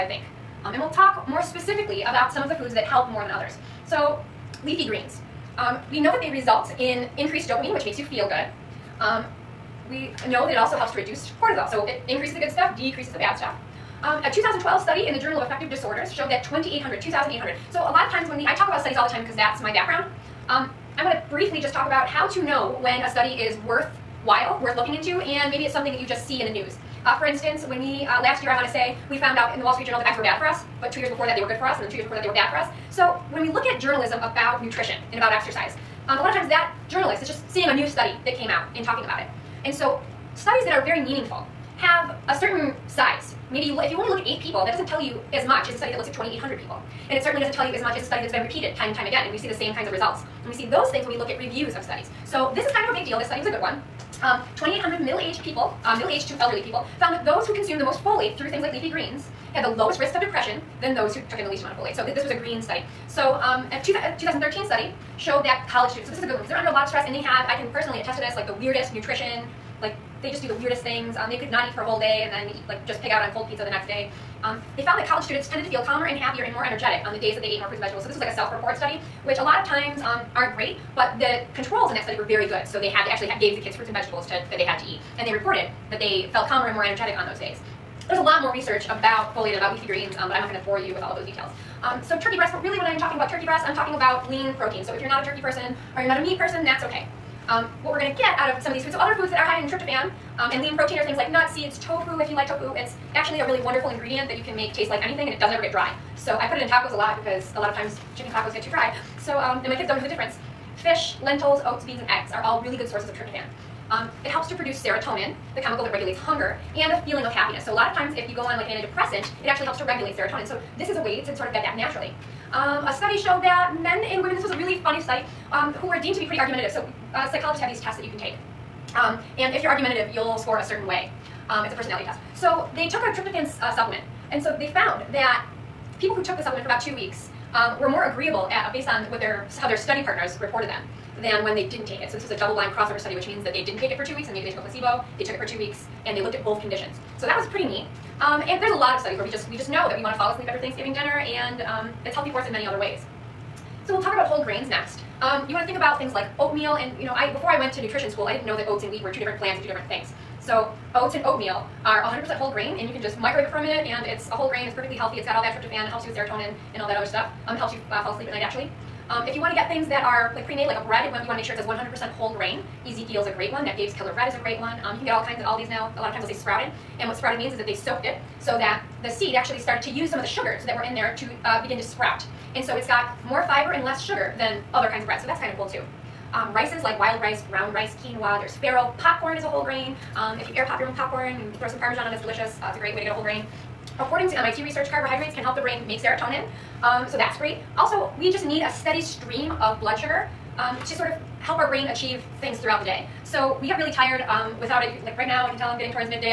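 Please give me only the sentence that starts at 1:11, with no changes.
Um, they could not eat for a whole day and then eat, like just pig out on cold pizza the next day.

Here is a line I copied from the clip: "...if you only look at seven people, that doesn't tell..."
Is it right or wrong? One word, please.
wrong.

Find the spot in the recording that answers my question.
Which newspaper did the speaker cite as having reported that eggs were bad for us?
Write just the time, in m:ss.
0:29.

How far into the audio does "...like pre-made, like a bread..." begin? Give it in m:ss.
2:50.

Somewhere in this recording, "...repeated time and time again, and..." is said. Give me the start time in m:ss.
0:48.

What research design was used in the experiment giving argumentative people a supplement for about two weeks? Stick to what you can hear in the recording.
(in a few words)
double-blind crossover study.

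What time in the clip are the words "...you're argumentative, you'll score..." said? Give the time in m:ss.
2:09.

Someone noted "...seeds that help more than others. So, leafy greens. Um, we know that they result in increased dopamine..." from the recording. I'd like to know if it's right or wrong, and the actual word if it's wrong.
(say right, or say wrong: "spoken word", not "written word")
wrong: "foods", not "seeds".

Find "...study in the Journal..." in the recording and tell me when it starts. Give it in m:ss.
0:14.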